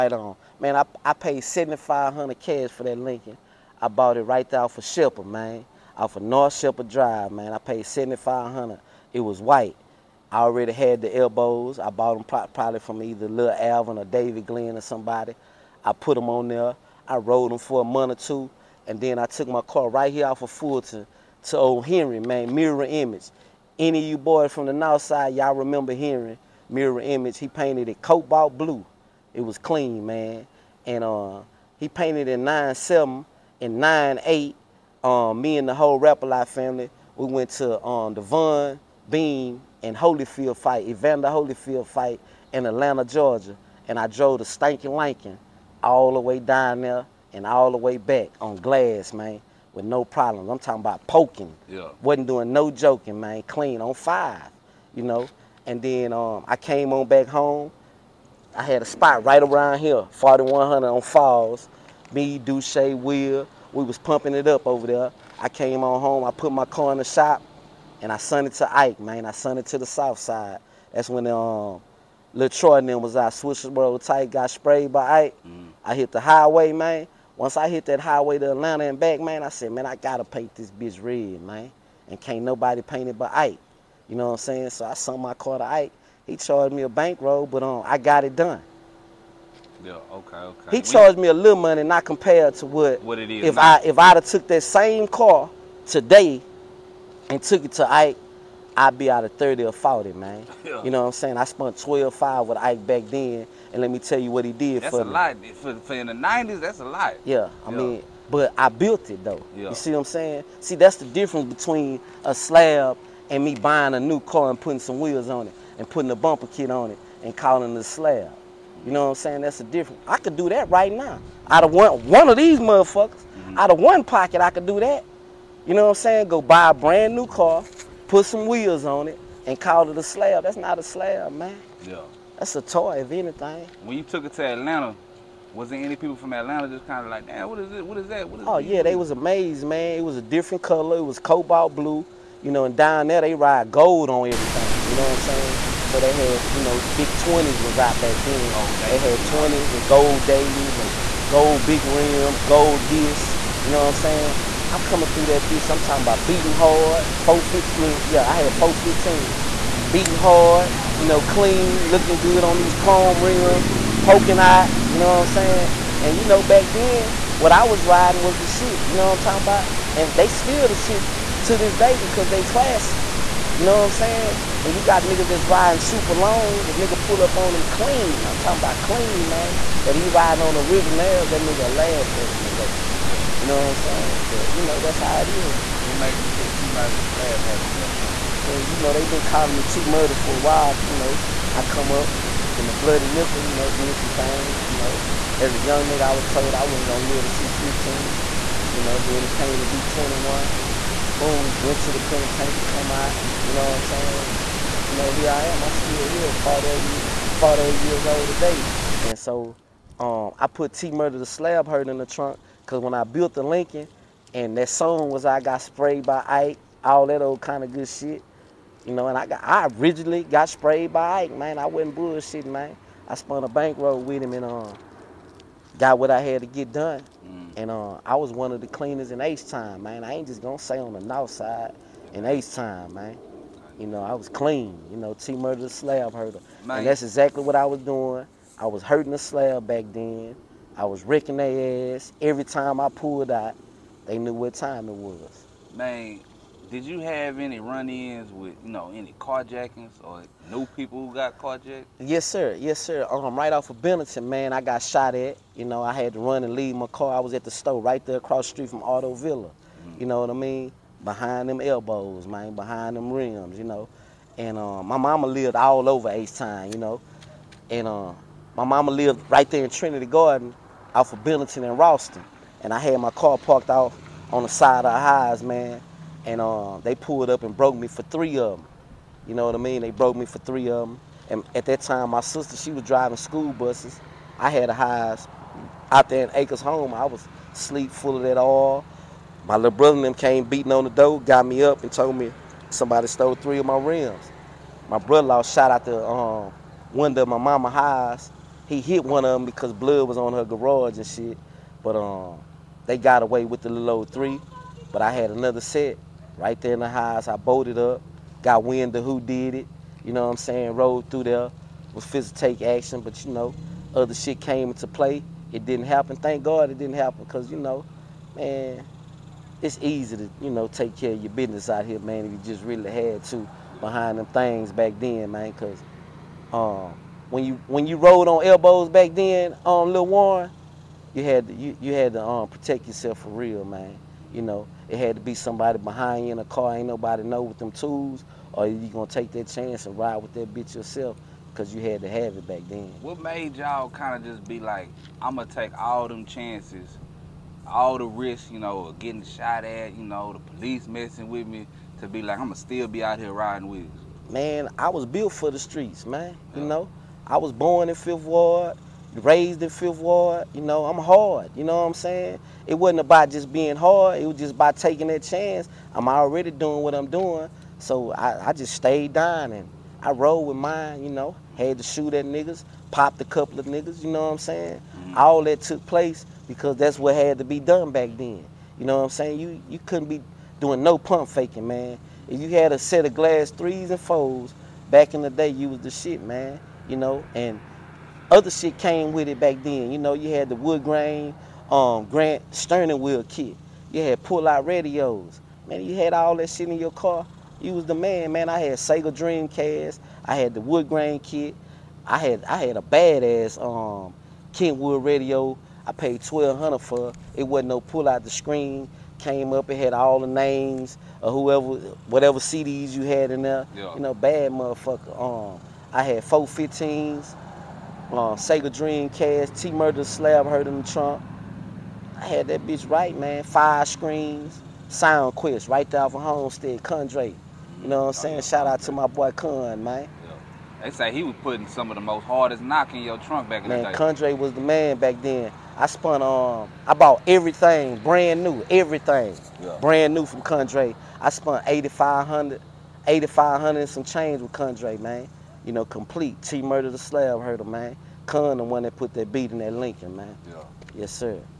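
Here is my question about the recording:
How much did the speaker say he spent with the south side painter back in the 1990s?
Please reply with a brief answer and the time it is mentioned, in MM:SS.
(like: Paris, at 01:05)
12,500, at 01:41.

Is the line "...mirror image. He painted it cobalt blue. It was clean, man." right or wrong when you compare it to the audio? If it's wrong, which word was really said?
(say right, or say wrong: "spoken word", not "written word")
right.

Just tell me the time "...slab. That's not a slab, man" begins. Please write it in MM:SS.
02:10.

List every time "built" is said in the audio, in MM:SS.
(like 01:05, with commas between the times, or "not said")
01:48, 03:33, 05:55.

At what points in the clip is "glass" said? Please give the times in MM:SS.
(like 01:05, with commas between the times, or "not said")
00:48, 06:23.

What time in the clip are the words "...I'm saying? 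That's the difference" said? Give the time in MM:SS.
01:59.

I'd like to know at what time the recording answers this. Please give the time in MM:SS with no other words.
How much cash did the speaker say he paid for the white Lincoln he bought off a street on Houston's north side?
00:01.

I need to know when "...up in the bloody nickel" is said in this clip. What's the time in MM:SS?
03:11.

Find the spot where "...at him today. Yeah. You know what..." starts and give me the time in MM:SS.
03:02.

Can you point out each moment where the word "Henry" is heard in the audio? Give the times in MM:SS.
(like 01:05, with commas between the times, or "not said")
00:21, 00:25.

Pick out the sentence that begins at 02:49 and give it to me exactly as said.
And they still the shit to this day because they classics.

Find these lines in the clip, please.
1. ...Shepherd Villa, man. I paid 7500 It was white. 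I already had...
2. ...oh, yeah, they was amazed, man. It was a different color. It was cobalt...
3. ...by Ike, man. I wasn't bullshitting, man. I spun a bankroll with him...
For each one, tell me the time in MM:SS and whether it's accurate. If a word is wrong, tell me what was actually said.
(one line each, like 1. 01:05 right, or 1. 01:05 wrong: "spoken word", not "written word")
1. 00:06 wrong: "Drive", not "Villa"
2. 02:18 right
3. 03:40 right.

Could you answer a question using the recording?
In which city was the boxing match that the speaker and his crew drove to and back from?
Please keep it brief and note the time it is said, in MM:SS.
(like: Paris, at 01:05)
Atlanta, Georgia, at 00:42.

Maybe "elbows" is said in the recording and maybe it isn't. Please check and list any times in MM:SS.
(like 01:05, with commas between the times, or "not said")
00:11, 04:21, 05:28.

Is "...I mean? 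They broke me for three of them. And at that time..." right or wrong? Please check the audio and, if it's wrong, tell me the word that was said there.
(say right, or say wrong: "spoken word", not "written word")
right.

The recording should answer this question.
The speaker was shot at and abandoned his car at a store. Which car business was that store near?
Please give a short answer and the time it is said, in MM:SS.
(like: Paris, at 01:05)
Auto Villa, at 04:18.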